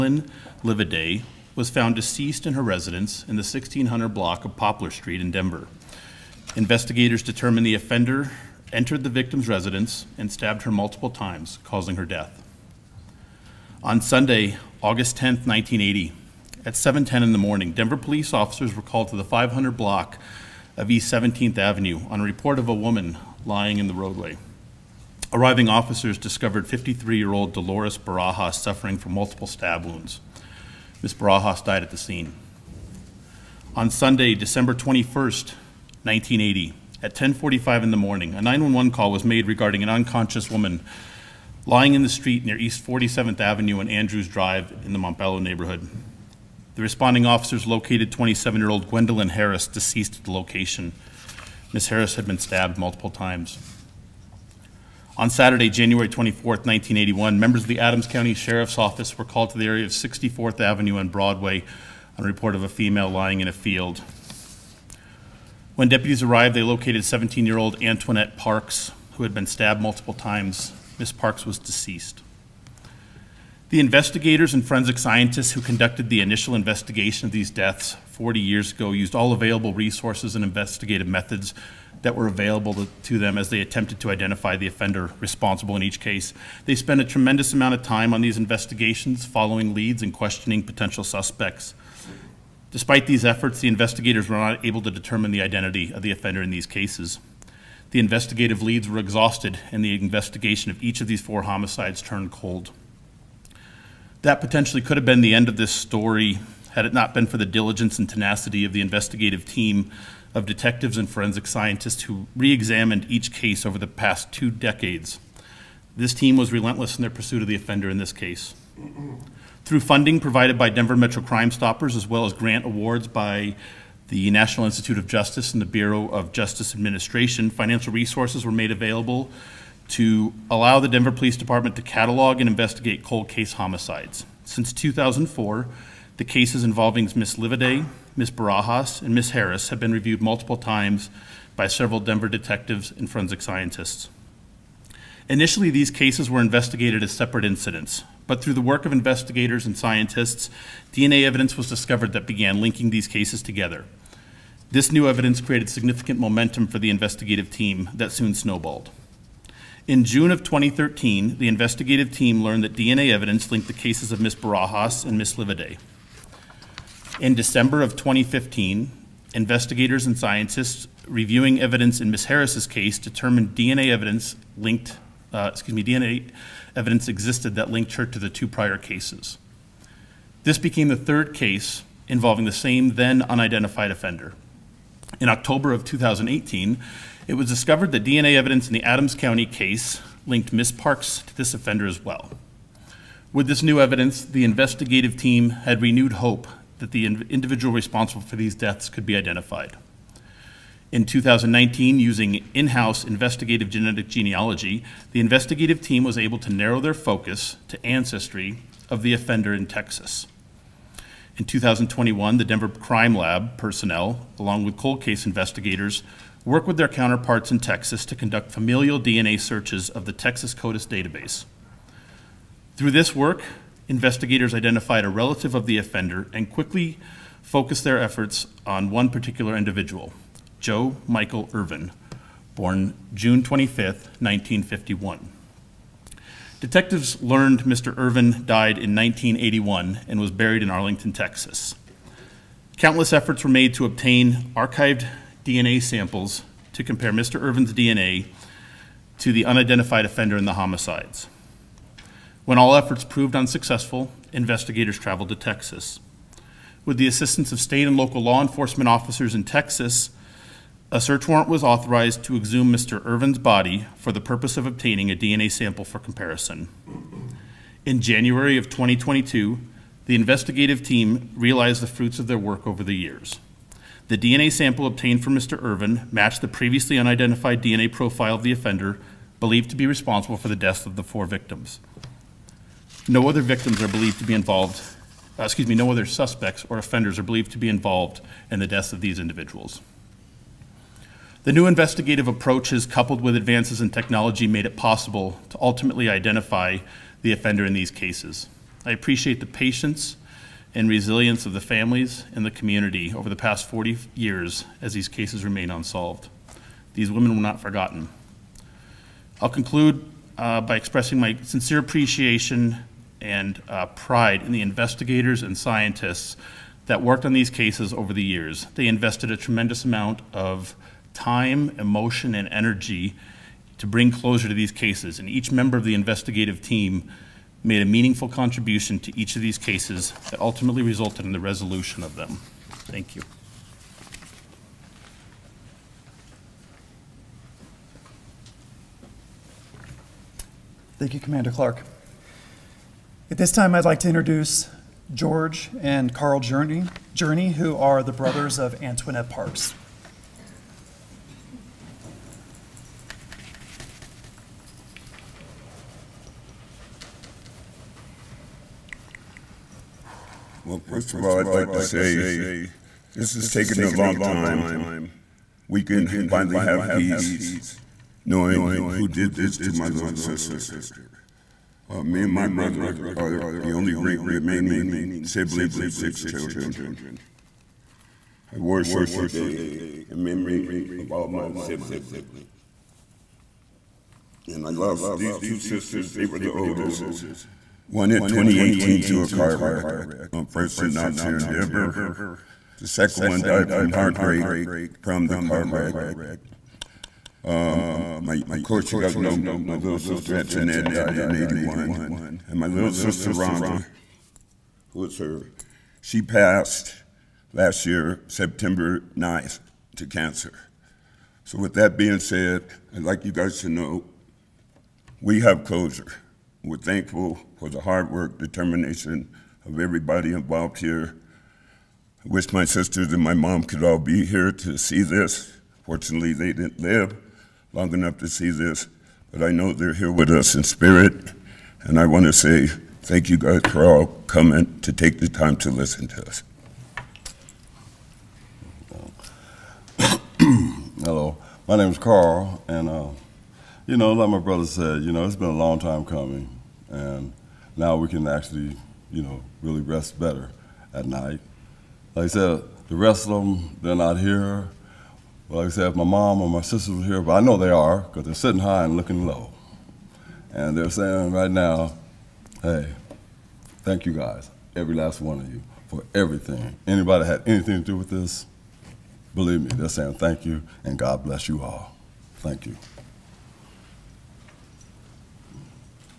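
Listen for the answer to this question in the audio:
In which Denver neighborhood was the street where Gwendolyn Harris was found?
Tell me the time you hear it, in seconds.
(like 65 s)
44 s.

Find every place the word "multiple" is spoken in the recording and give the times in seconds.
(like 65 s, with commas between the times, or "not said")
10 s, 29 s, 52 s, 69 s, 140 s.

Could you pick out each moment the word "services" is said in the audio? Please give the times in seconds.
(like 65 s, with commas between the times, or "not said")
not said.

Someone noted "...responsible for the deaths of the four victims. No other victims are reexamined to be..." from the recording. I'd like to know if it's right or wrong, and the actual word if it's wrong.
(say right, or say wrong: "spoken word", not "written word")
wrong: "believed", not "reexamined".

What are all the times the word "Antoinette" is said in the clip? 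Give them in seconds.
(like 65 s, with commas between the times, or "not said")
67 s, 348 s, 400 s.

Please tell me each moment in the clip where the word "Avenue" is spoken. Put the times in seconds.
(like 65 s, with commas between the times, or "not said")
21 s, 43 s, 60 s.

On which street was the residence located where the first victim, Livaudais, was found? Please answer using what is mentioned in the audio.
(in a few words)
Poplar Street.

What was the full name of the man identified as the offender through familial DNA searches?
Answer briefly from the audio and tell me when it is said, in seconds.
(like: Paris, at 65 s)
Joe Michael Ervin, at 230 s.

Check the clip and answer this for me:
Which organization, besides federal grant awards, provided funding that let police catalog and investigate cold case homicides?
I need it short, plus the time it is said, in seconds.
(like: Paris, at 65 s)
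Denver Metro Crime Stoppers, at 120 s.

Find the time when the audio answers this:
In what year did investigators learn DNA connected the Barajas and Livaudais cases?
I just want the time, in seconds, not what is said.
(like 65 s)
160 s.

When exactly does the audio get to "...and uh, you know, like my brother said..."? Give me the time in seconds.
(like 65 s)
442 s.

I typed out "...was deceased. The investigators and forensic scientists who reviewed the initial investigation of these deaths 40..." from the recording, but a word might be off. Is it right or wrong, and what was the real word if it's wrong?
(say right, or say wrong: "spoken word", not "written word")
wrong: "conducted", not "reviewed".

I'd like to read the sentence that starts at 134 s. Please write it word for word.
Since 2004, the cases involving Ms.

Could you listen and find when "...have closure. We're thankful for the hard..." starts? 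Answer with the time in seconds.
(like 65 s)
415 s.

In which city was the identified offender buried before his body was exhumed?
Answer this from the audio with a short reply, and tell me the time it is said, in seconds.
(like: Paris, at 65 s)
Arlington, Texas, at 240 s.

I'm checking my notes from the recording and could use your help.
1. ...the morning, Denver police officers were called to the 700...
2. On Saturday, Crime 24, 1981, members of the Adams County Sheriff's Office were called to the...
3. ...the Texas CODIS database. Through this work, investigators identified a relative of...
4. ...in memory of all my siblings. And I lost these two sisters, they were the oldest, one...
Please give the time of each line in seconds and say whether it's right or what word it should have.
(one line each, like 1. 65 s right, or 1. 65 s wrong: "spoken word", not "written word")
1. 17 s wrong: "500", not "700"
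2. 55 s wrong: "January", not "Crime"
3. 220 s right
4. 380 s right.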